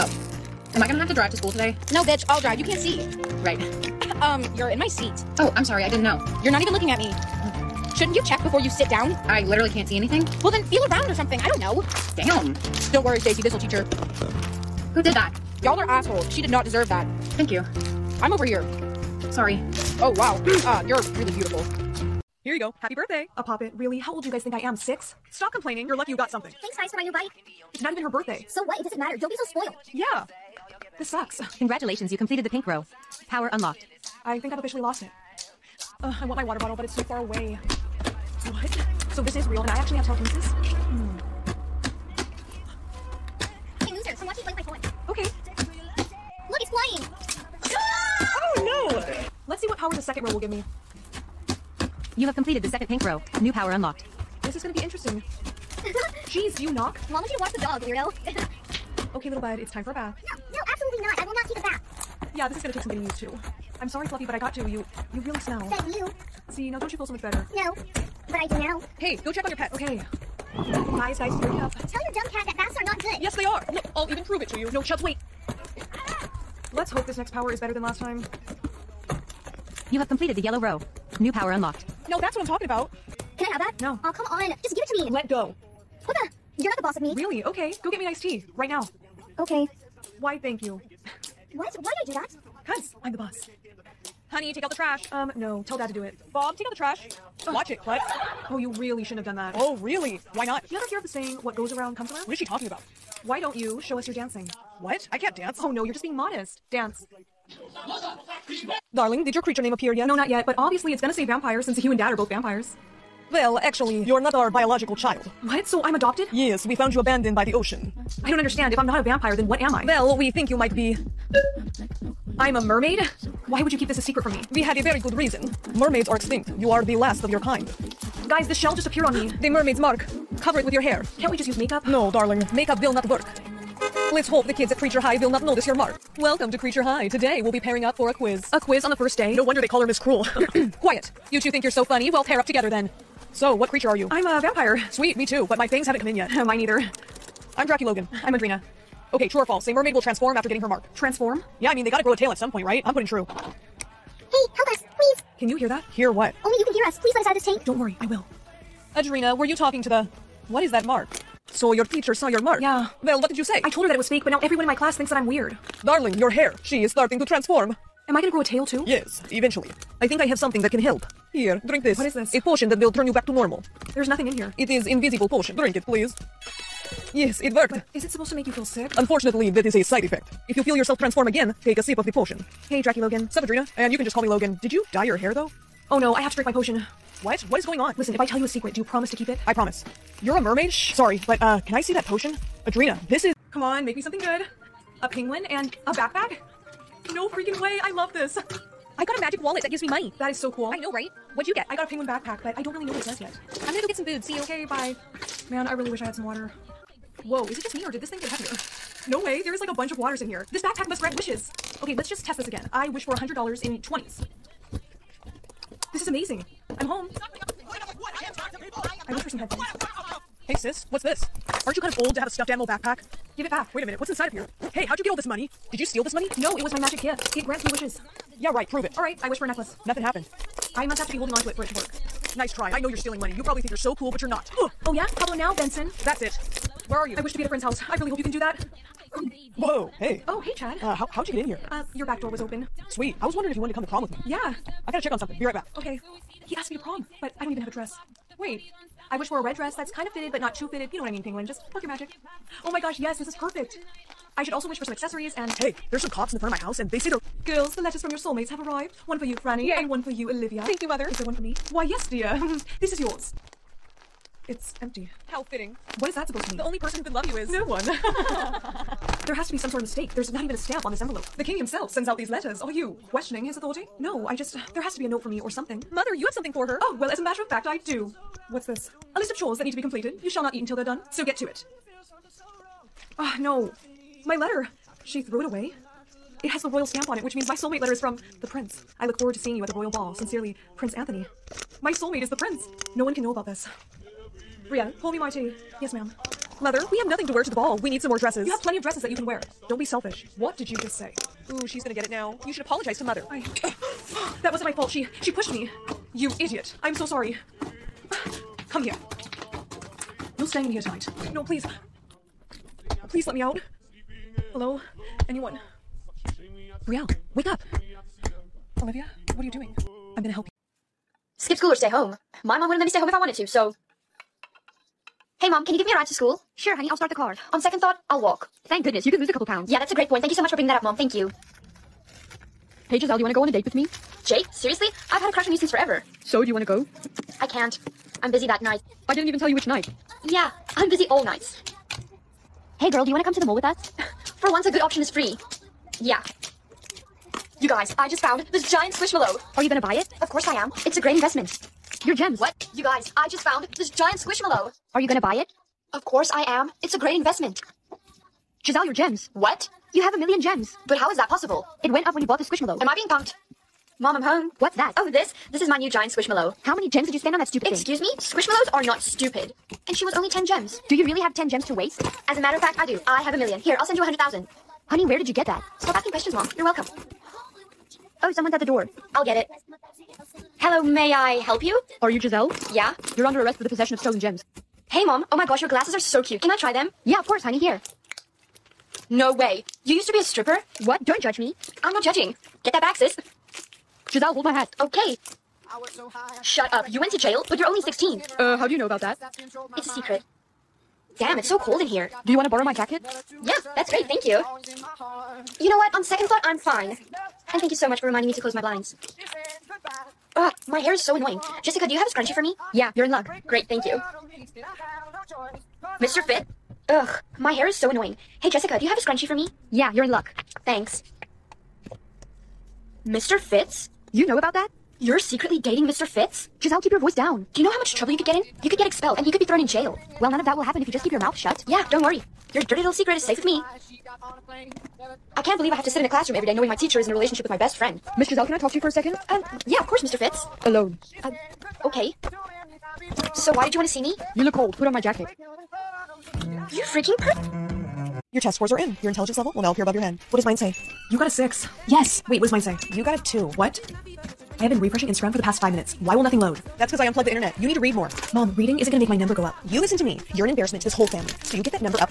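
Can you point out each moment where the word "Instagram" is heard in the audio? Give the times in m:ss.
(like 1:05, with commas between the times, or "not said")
7:35.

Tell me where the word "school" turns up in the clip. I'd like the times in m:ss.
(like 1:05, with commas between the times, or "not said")
0:01, 5:21, 5:26.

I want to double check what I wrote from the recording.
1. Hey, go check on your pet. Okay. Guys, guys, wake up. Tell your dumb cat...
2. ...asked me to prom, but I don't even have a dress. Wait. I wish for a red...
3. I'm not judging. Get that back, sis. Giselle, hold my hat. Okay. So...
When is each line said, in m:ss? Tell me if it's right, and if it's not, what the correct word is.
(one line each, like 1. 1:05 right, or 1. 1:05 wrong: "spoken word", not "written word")
1. 1:08 right
2. 4:06 right
3. 6:31 right.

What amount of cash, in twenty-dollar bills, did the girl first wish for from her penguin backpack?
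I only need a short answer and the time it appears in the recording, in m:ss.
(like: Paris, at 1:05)
$100, at 3:33.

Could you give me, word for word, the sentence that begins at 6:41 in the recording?
Damn, it's so cold in here.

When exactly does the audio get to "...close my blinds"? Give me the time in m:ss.
6:48.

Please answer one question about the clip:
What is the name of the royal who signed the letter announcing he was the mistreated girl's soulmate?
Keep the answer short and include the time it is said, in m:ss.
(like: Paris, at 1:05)
Prince Anthony, at 4:50.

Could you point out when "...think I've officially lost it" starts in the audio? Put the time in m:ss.
0:34.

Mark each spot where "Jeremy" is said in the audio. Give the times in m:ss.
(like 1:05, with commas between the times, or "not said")
not said.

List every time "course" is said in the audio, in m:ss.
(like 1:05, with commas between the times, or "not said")
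5:50, 5:56, 6:27, 7:19.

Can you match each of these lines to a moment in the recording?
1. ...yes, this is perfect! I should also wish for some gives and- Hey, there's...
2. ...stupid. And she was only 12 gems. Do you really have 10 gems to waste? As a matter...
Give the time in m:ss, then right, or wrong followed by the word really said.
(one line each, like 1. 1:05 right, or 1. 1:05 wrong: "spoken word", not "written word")
1. 4:12 wrong: "accessories", not "gives"
2. 6:08 wrong: "10", not "12".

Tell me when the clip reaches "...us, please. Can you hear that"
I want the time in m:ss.
2:34.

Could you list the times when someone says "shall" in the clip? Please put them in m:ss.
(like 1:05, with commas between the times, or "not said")
4:40.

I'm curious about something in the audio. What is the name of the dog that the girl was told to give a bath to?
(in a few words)
Fluffy.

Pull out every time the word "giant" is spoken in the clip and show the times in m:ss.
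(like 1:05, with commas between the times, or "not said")
5:48, 5:53, 6:05.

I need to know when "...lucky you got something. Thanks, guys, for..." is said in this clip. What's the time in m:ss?
0:25.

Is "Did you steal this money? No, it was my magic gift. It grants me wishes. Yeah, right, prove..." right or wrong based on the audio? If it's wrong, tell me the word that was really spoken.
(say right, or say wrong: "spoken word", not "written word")
right.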